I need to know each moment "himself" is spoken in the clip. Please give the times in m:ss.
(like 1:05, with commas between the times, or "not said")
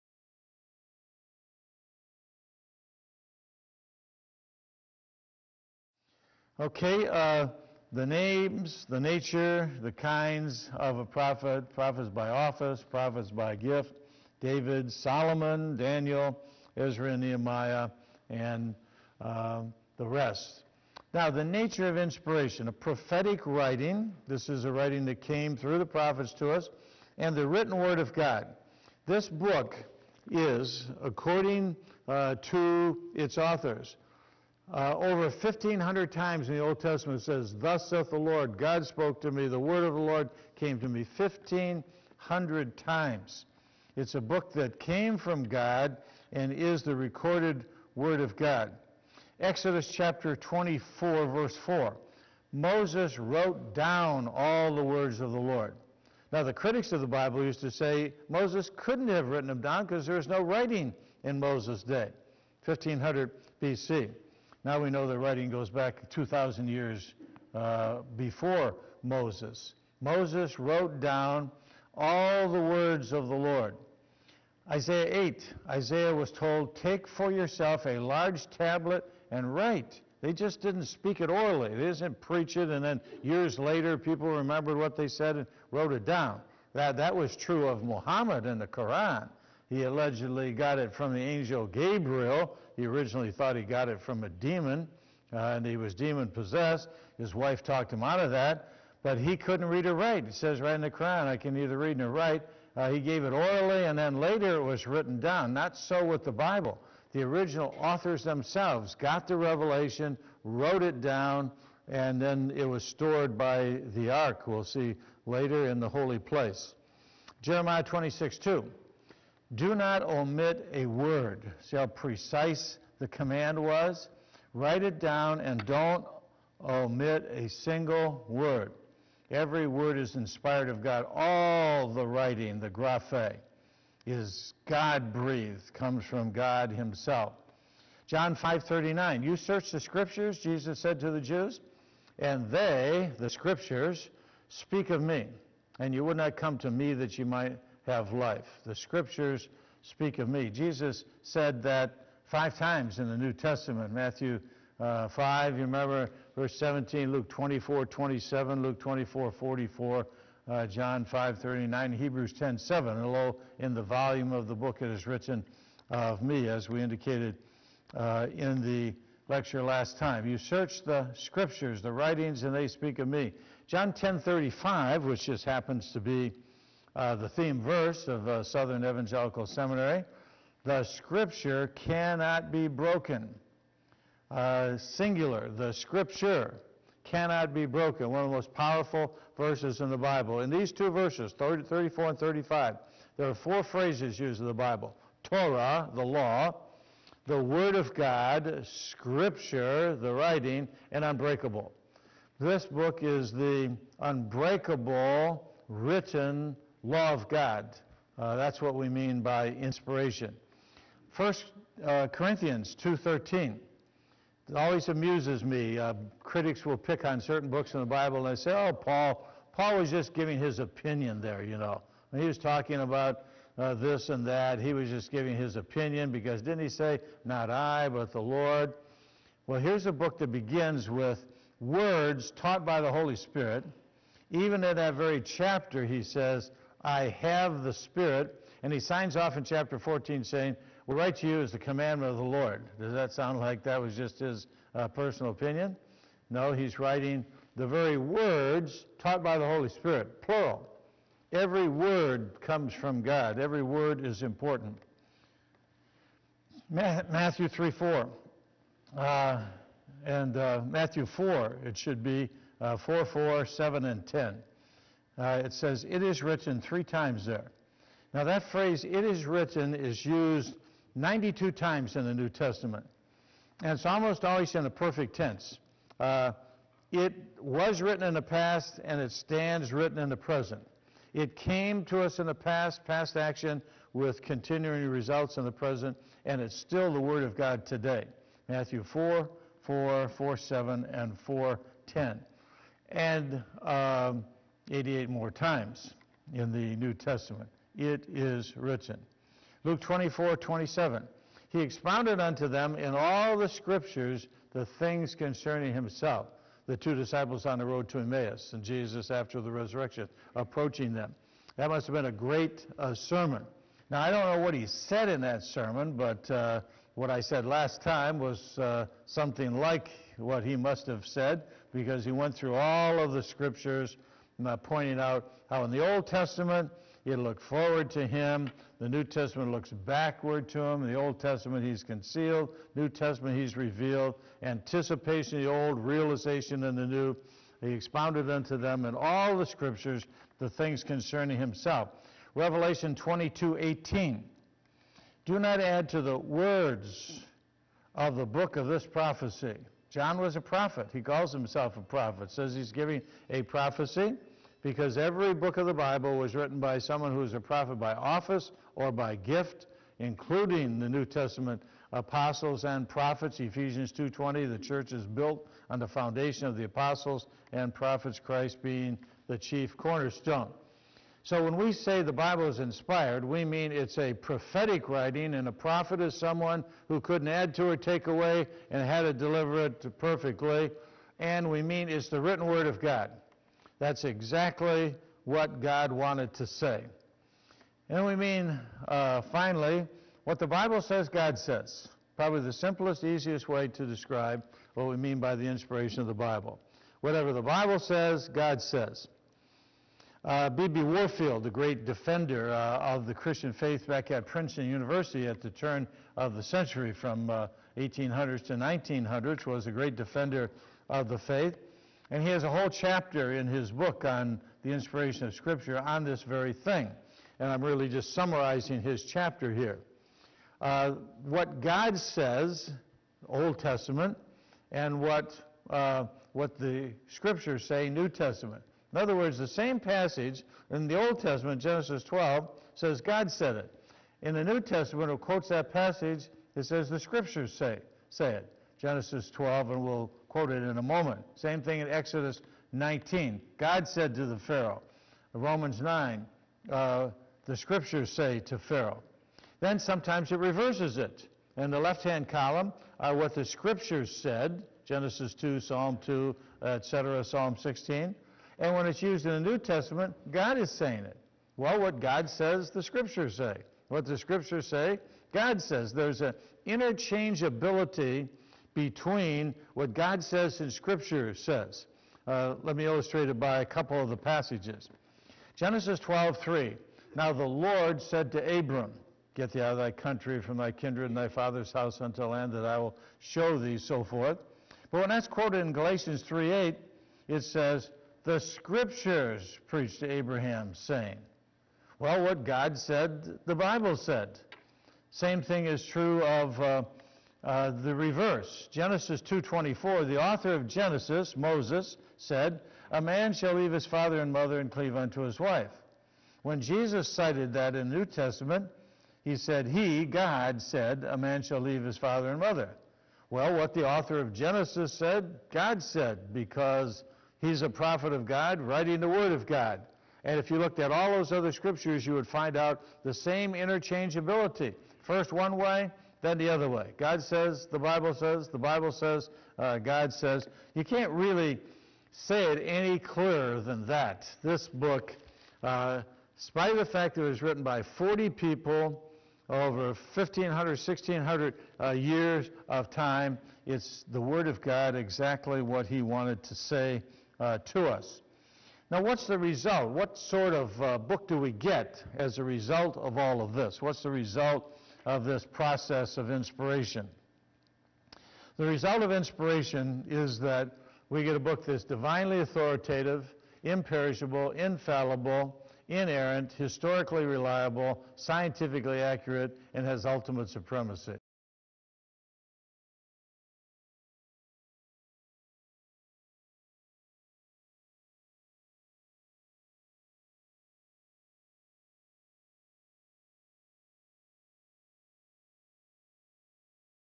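2:16, 5:05, 5:41, 5:51.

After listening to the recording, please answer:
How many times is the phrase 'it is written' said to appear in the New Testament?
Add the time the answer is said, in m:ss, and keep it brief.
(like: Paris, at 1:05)
92, at 4:30.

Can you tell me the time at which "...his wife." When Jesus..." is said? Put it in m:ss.
8:25.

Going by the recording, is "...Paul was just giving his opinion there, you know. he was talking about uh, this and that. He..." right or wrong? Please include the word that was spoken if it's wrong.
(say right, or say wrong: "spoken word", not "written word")
right.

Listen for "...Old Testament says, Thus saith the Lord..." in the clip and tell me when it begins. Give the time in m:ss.
0:36.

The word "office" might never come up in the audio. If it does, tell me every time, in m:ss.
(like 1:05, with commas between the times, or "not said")
0:12, 5:57.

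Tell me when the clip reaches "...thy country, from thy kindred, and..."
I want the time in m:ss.
7:59.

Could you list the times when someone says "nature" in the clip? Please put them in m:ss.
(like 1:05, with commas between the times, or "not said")
0:08, 0:21.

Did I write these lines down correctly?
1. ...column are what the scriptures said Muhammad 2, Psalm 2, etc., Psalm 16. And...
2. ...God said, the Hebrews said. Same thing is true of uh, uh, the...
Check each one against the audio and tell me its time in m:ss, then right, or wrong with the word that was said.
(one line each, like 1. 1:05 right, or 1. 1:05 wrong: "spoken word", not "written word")
1. 7:32 wrong: "Genesis", not "Muhammad"
2. 8:12 wrong: "Bible", not "Hebrews".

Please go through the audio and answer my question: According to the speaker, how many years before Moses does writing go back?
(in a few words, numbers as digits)
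2,000.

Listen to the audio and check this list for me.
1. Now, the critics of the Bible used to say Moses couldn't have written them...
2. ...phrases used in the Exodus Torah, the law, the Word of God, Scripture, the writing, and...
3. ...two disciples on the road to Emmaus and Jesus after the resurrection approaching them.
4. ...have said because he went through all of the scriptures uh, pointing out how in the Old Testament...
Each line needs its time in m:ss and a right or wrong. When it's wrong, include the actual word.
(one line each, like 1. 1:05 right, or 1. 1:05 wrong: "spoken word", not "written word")
1. 0:56 right
2. 3:13 wrong: "Bible", not "Exodus"
3. 5:06 right
4. 5:20 right.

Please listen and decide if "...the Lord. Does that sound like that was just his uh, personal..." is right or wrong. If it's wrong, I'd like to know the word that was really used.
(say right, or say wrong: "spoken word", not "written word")
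right.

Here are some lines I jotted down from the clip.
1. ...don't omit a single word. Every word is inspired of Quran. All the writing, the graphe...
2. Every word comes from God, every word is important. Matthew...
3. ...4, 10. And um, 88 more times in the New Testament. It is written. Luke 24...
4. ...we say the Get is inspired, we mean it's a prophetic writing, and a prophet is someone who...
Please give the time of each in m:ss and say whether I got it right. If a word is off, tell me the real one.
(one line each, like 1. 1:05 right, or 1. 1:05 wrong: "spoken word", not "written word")
1. 2:05 wrong: "God", not "Quran"
2. 4:11 right
3. 4:51 right
4. 6:11 wrong: "Bible", not "Get".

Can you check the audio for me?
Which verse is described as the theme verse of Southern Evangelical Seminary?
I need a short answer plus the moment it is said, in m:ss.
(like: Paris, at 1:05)
John 10:35, at 2:53.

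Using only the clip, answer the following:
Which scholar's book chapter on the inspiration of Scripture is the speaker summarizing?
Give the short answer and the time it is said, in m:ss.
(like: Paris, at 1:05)
B.B. Warfield, at 6:40.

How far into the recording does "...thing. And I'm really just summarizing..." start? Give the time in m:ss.
6:56.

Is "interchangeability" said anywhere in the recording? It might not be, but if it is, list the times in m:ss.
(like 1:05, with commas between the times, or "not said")
7:46, 8:43.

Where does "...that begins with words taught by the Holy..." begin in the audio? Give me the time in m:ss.
3:50.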